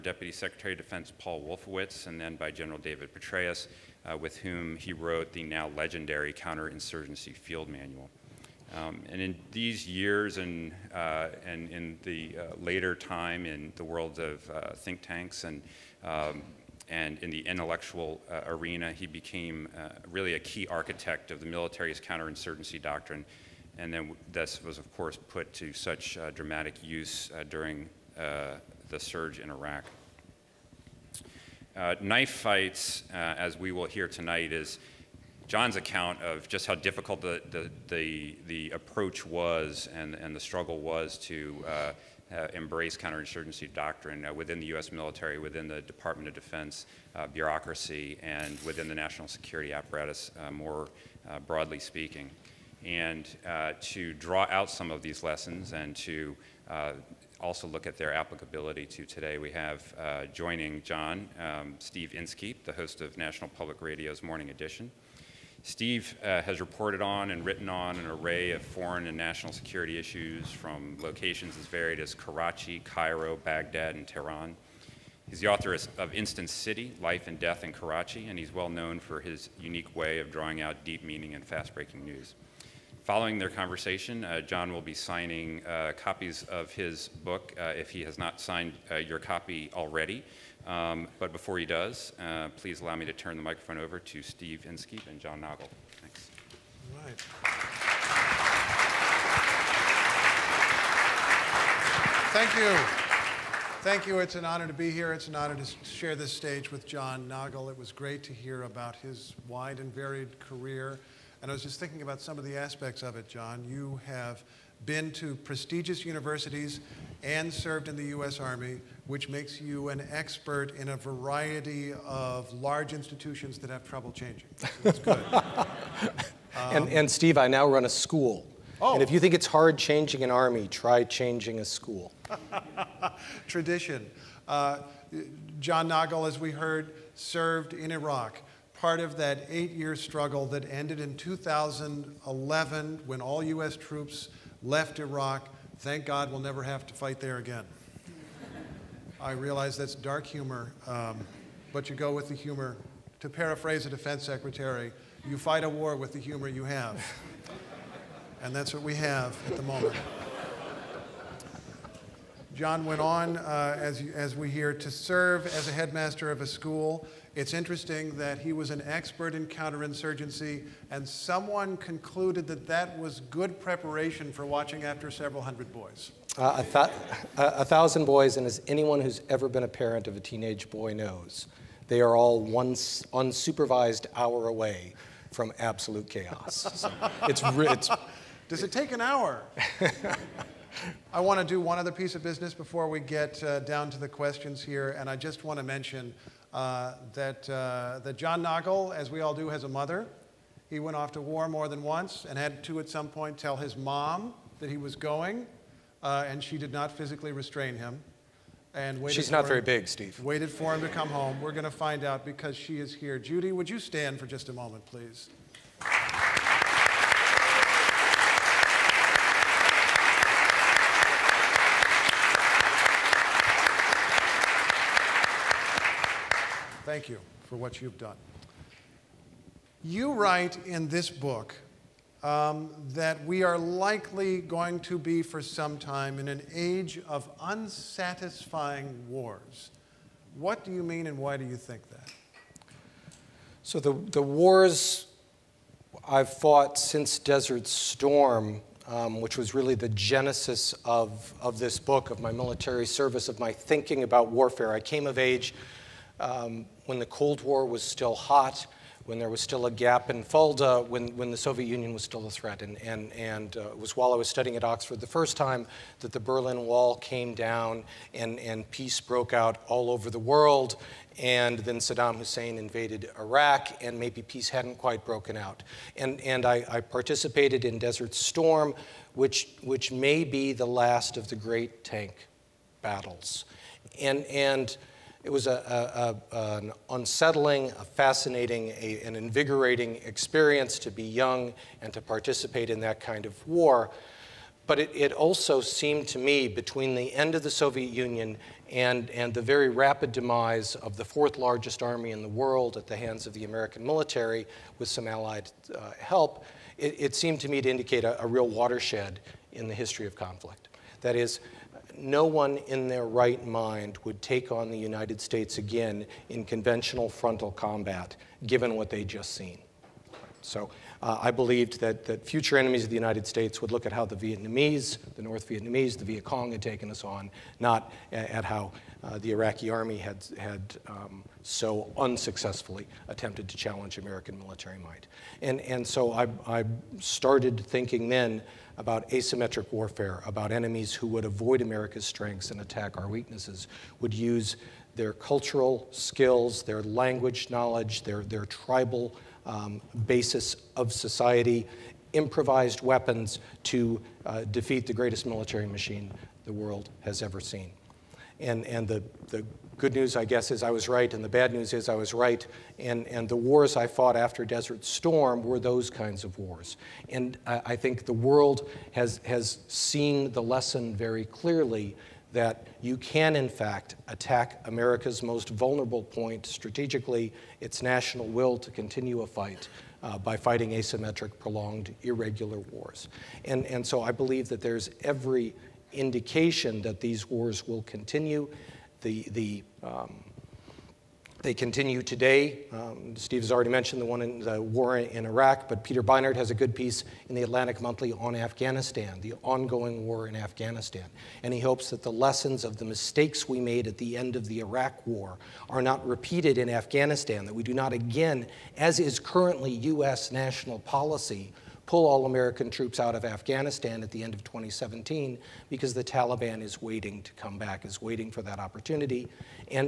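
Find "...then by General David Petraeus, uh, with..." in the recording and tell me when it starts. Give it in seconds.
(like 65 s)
2 s.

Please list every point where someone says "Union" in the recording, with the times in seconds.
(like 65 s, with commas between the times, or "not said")
261 s, 297 s.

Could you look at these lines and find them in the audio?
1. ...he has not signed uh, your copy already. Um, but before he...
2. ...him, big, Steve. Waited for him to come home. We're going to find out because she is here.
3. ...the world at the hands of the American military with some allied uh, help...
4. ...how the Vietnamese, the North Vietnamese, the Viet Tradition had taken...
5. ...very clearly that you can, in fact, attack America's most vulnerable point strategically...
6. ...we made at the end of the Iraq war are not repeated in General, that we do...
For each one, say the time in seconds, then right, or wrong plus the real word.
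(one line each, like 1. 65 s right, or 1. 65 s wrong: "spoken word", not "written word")
1. 87 s right
2. 209 s right
3. 302 s right
4. 323 s wrong: "Cong", not "Tradition"
5. 370 s right
6. 403 s wrong: "Afghanistan", not "General".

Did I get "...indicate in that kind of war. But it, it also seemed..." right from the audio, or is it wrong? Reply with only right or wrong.
wrong.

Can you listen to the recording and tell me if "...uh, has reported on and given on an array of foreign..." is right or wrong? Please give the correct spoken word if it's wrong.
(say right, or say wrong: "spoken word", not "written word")
wrong: "written", not "given".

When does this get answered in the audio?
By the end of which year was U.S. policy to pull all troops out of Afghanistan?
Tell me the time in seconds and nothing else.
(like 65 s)
414 s.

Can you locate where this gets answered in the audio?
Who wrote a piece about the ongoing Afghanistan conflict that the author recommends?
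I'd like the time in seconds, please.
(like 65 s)
395 s.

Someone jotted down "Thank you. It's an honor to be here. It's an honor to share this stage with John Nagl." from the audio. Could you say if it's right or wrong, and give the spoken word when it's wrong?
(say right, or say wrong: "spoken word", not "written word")
right.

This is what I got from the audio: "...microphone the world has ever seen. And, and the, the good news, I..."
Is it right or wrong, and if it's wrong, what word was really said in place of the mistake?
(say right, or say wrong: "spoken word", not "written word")
wrong: "machine", not "microphone".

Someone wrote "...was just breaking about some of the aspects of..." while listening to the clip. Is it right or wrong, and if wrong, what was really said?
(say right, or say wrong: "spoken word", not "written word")
wrong: "thinking", not "breaking".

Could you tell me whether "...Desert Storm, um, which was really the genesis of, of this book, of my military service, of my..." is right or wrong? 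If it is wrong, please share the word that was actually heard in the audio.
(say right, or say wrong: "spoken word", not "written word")
right.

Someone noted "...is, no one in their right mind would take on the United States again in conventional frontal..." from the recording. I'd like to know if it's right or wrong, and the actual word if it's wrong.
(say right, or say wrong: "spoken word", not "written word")
right.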